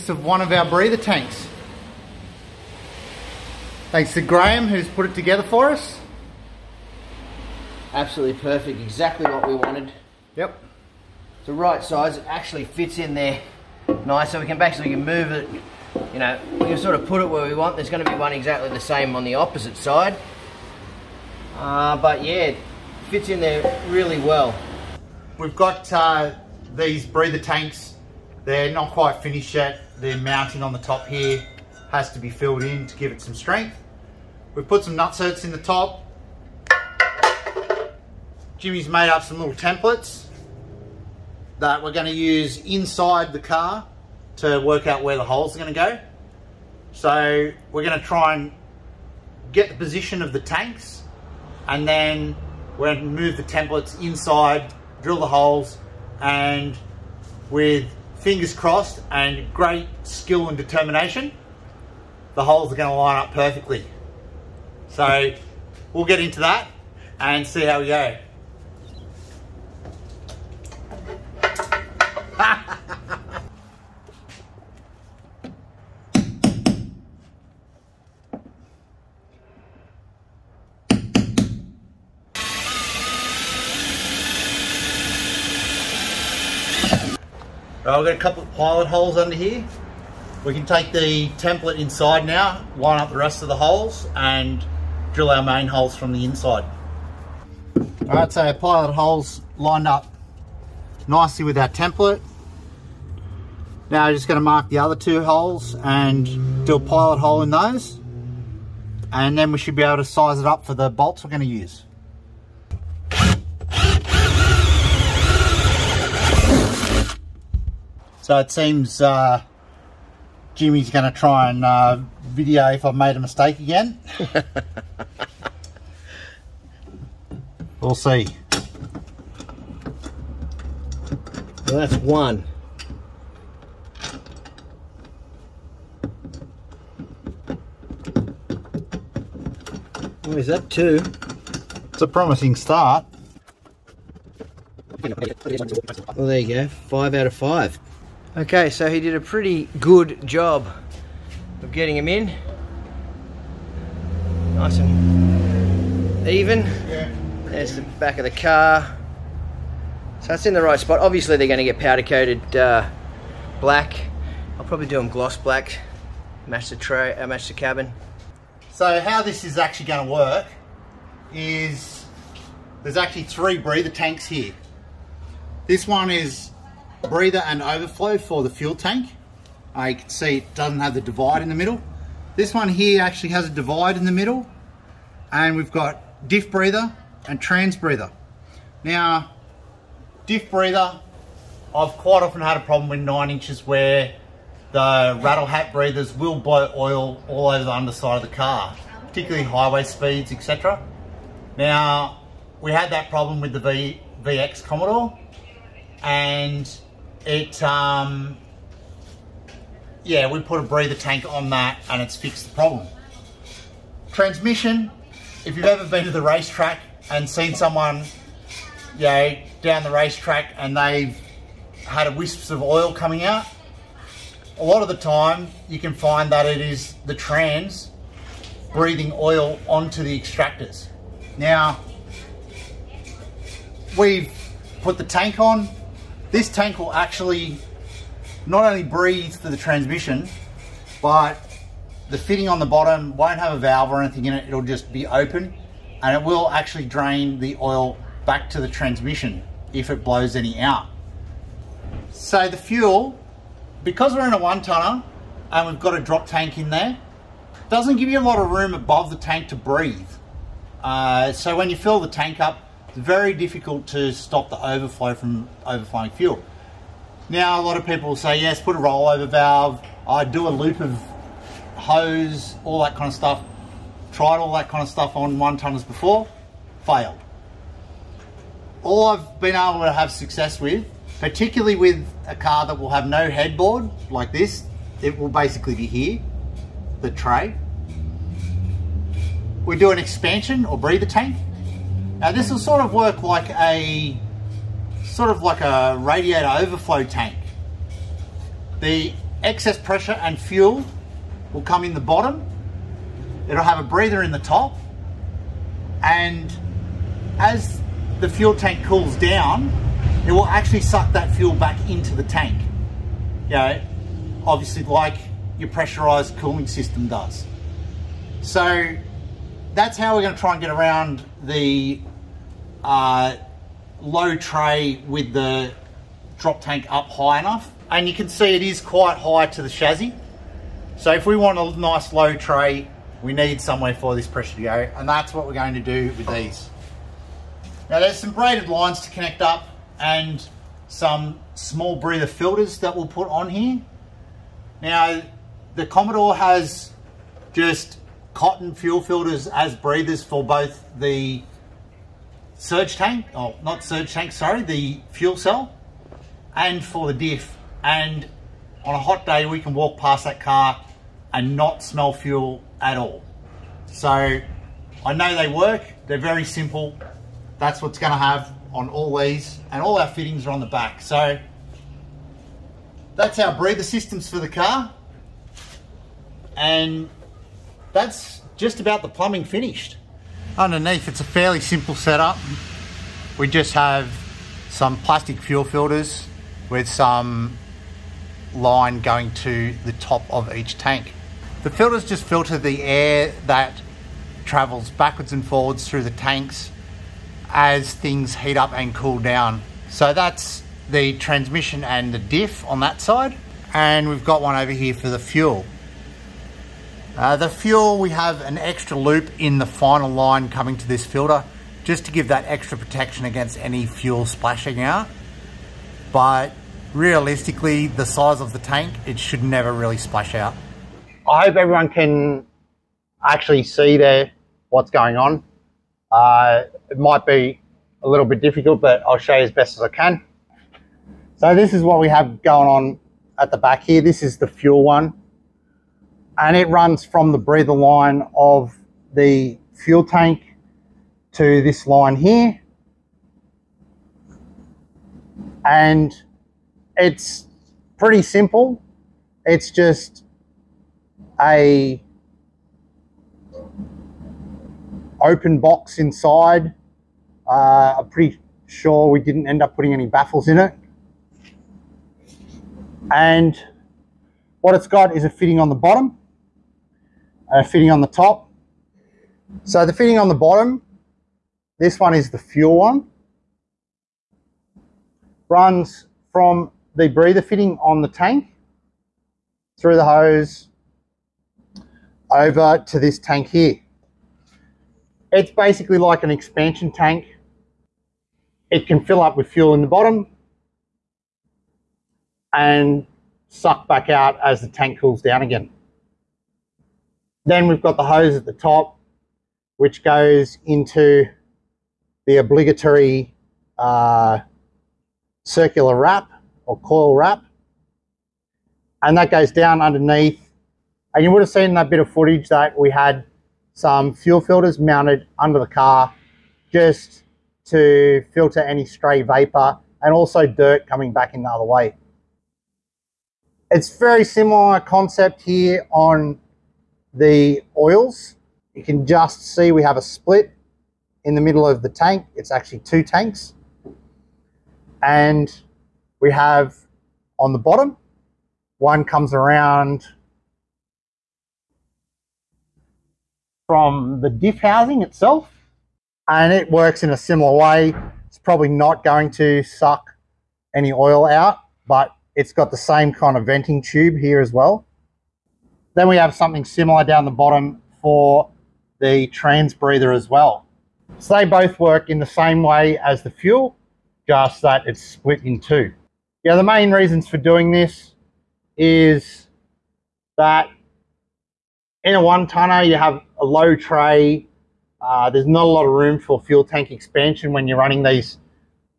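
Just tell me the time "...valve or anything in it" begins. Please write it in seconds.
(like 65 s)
243 s.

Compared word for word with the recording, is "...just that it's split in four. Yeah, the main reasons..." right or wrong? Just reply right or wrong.
wrong.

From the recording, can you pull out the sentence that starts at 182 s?
This one here actually has a divide in the middle and we've got diff breather and trans breather.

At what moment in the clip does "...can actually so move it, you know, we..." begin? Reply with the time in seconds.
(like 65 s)
14 s.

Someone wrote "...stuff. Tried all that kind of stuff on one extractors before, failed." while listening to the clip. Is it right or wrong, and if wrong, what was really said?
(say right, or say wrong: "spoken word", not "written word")
wrong: "tonners", not "extractors".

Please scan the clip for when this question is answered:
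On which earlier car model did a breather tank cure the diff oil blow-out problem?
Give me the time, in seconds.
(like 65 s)
204 s.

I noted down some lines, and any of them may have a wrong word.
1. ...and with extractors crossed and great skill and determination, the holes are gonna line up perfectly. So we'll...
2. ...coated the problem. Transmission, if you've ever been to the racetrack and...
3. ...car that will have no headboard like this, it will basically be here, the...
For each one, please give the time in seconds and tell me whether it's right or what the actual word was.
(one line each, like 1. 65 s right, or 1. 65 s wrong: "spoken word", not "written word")
1. 56 s wrong: "fingers", not "extractors"
2. 212 s wrong: "fixed", not "coated"
3. 282 s right.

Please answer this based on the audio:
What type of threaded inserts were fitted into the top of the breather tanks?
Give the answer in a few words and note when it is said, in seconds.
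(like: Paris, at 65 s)
Nutserts, at 34 s.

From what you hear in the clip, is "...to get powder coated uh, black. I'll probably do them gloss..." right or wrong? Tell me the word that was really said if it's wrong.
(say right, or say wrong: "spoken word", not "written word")
right.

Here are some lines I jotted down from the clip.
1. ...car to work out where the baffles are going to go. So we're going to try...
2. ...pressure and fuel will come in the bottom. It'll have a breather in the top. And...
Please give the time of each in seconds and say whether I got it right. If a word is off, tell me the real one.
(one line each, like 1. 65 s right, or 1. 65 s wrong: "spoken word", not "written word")
1. 43 s wrong: "holes", not "baffles"
2. 299 s right.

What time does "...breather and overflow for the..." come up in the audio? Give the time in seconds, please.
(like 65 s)
177 s.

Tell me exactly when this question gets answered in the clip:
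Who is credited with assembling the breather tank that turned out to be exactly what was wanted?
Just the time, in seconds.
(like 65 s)
4 s.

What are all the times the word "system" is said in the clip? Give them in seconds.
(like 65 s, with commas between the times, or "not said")
316 s, 373 s.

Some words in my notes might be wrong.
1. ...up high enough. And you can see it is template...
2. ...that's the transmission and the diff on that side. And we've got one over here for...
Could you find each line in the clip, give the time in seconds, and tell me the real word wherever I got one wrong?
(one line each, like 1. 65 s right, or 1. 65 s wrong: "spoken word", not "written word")
1. 326 s wrong: "quite", not "template"
2. 400 s right.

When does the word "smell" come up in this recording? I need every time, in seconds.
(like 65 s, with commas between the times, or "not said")
361 s.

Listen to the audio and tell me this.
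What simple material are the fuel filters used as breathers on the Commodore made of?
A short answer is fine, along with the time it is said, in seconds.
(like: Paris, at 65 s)
Cotton, at 348 s.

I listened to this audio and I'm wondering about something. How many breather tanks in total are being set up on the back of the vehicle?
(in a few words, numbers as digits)
Three.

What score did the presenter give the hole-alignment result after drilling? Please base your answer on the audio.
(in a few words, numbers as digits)
Five out of five.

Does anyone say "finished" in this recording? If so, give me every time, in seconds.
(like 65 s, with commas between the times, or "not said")
29 s, 379 s.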